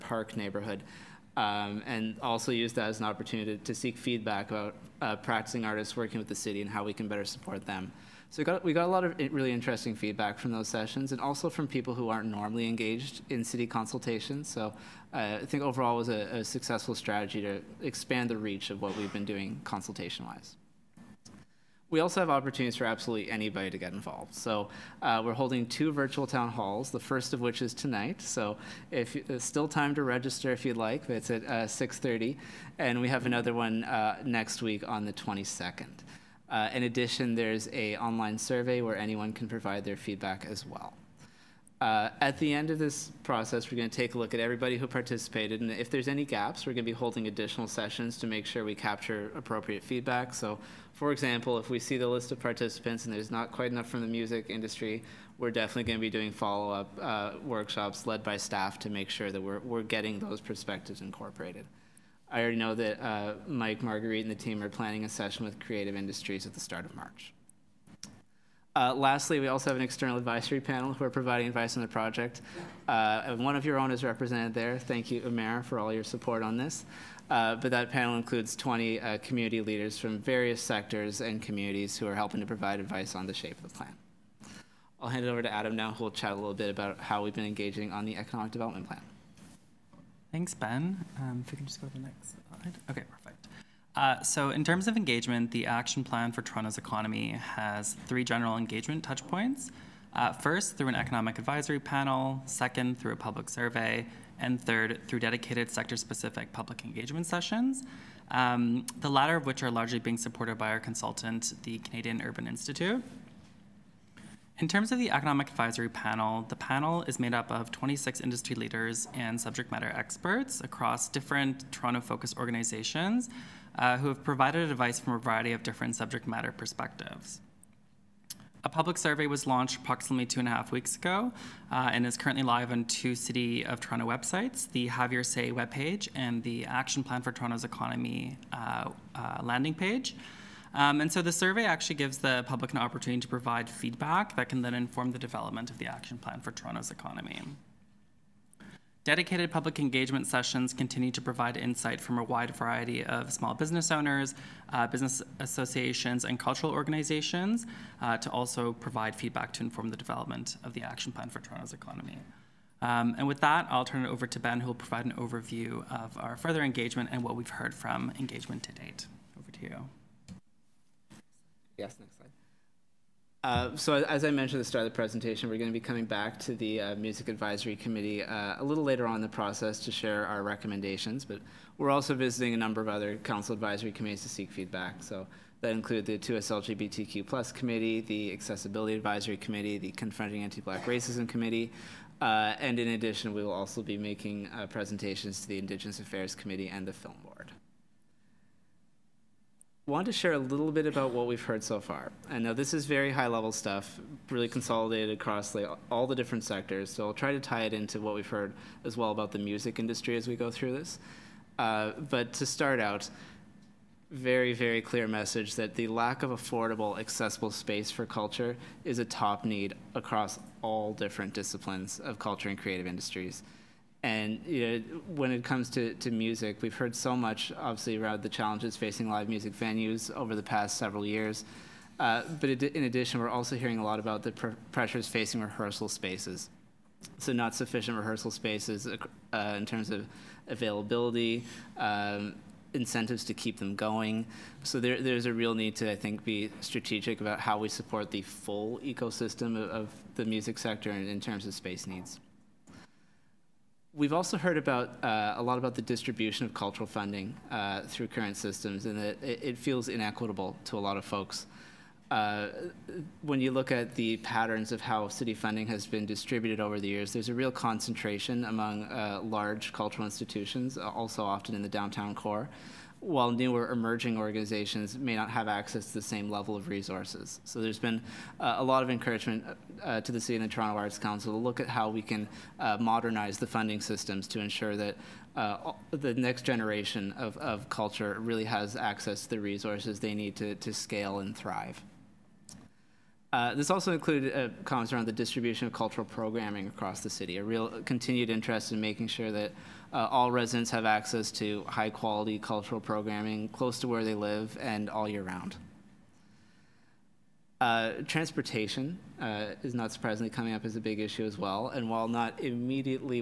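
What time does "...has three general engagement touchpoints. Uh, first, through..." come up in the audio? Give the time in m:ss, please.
1:37.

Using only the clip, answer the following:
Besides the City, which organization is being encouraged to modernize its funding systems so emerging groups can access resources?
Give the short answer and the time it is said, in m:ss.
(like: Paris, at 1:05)
Toronto Arts Council, at 4:40.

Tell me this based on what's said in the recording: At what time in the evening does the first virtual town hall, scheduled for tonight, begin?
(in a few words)
6:30.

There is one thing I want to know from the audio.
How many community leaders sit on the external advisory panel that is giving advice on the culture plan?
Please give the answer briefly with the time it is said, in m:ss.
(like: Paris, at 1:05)
20, at 1:18.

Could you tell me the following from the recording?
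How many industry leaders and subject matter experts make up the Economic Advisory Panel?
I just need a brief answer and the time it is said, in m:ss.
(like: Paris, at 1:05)
26, at 1:57.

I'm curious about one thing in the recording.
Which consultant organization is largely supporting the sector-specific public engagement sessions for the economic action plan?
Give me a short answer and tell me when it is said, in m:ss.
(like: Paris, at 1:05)
Canadian Urban Institute, at 1:51.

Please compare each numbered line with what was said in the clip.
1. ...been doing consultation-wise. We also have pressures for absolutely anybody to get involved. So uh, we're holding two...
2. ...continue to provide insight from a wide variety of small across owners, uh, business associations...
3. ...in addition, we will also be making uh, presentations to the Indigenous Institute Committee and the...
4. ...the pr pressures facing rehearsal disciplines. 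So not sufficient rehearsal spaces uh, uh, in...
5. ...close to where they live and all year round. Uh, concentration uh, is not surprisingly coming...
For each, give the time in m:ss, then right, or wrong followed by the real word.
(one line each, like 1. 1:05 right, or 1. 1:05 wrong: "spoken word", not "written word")
1. 0:19 wrong: "opportunities", not "pressures"
2. 2:30 wrong: "business", not "across"
3. 3:12 wrong: "Affairs", not "Institute"
4. 3:54 wrong: "spaces", not "disciplines"
5. 5:03 wrong: "transportation", not "concentration".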